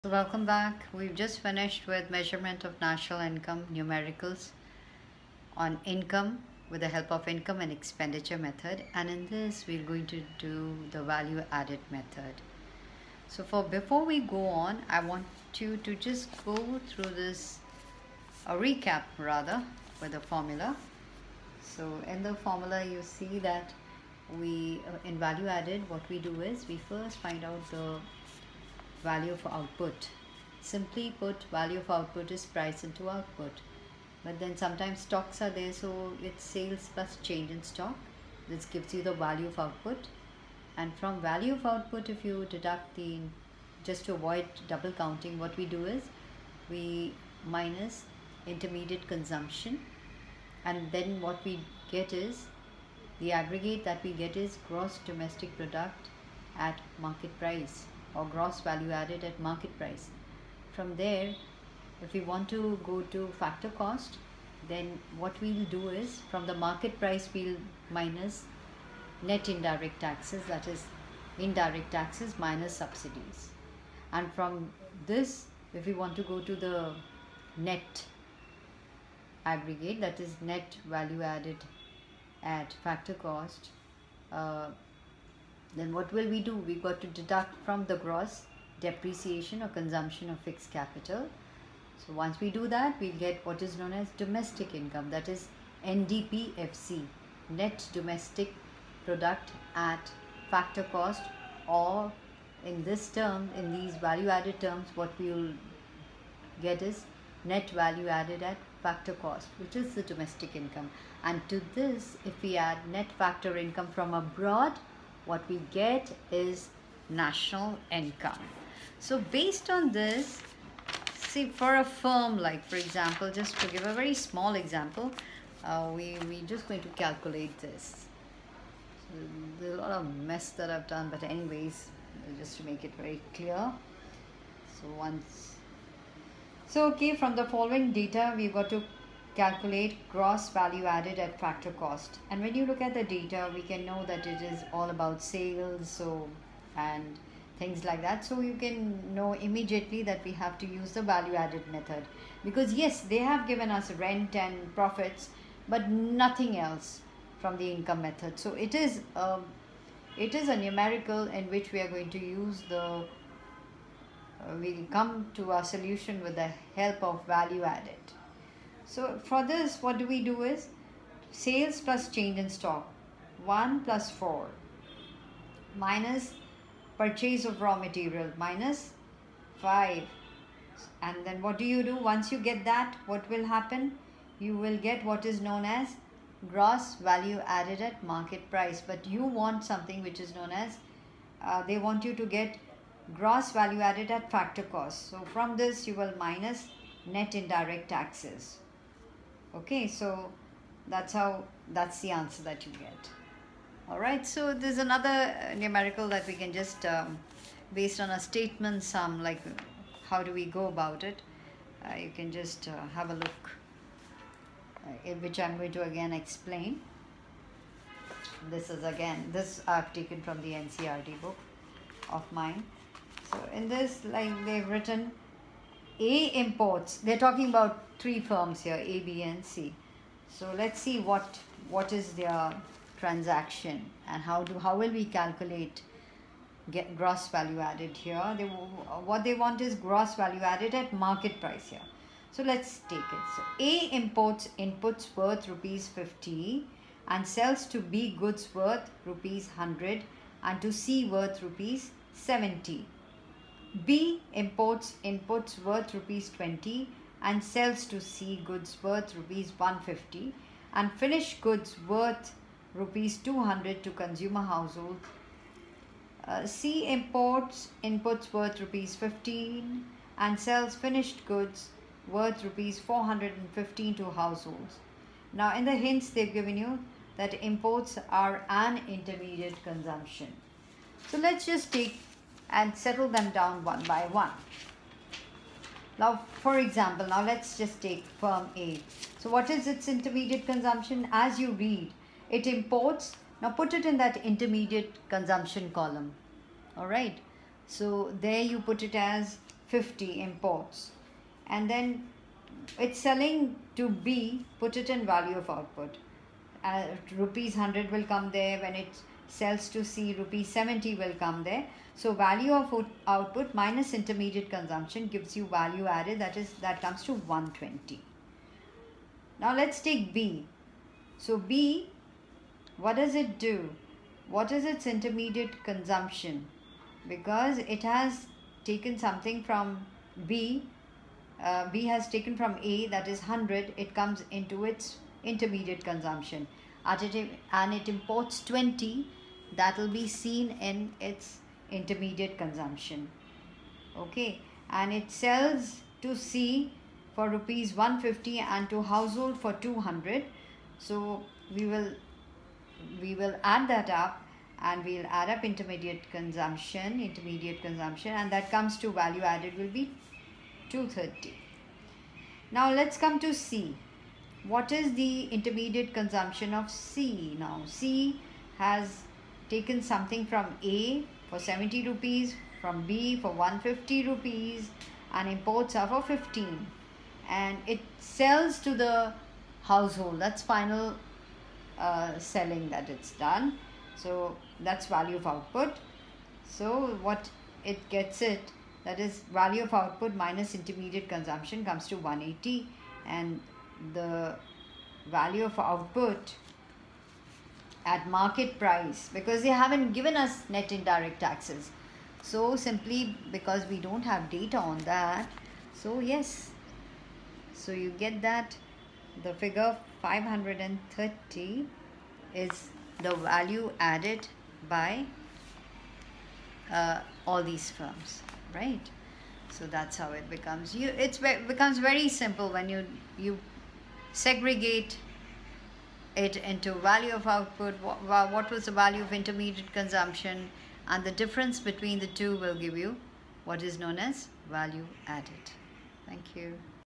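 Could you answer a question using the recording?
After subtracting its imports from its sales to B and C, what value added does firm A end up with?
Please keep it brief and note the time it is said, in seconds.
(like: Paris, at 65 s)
120, at 317 s.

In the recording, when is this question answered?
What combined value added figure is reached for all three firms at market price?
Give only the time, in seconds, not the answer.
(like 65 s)
410 s.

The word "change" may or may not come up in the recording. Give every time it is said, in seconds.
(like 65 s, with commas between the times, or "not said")
37 s, 172 s.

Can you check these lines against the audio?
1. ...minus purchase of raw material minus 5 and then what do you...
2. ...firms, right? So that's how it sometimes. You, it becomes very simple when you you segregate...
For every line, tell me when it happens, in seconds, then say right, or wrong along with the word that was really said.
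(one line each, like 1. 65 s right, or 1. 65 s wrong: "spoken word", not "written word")
1. 175 s right
2. 417 s wrong: "becomes", not "sometimes".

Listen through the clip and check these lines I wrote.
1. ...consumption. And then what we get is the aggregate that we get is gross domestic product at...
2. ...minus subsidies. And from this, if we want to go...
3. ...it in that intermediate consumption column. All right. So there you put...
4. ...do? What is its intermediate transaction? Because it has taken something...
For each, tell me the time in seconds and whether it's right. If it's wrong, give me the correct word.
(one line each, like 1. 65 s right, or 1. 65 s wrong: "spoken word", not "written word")
1. 49 s right
2. 72 s right
3. 293 s right
4. 323 s wrong: "consumption", not "transaction".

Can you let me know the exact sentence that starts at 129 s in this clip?
So there's a lot of mess that I've done but anyways, just to make it very clear.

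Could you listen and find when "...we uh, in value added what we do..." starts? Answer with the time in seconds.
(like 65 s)
24 s.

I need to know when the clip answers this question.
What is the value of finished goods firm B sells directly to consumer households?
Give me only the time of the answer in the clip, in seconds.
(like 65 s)
262 s.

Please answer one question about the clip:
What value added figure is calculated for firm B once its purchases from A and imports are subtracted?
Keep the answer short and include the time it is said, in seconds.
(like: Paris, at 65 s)
230, at 360 s.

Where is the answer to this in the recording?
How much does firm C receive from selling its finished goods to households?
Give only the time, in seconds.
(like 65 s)
272 s.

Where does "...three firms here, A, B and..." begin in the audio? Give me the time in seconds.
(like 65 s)
227 s.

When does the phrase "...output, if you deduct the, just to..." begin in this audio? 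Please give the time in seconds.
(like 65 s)
41 s.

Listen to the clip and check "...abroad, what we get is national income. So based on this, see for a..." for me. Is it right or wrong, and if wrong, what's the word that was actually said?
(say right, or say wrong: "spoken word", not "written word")
right.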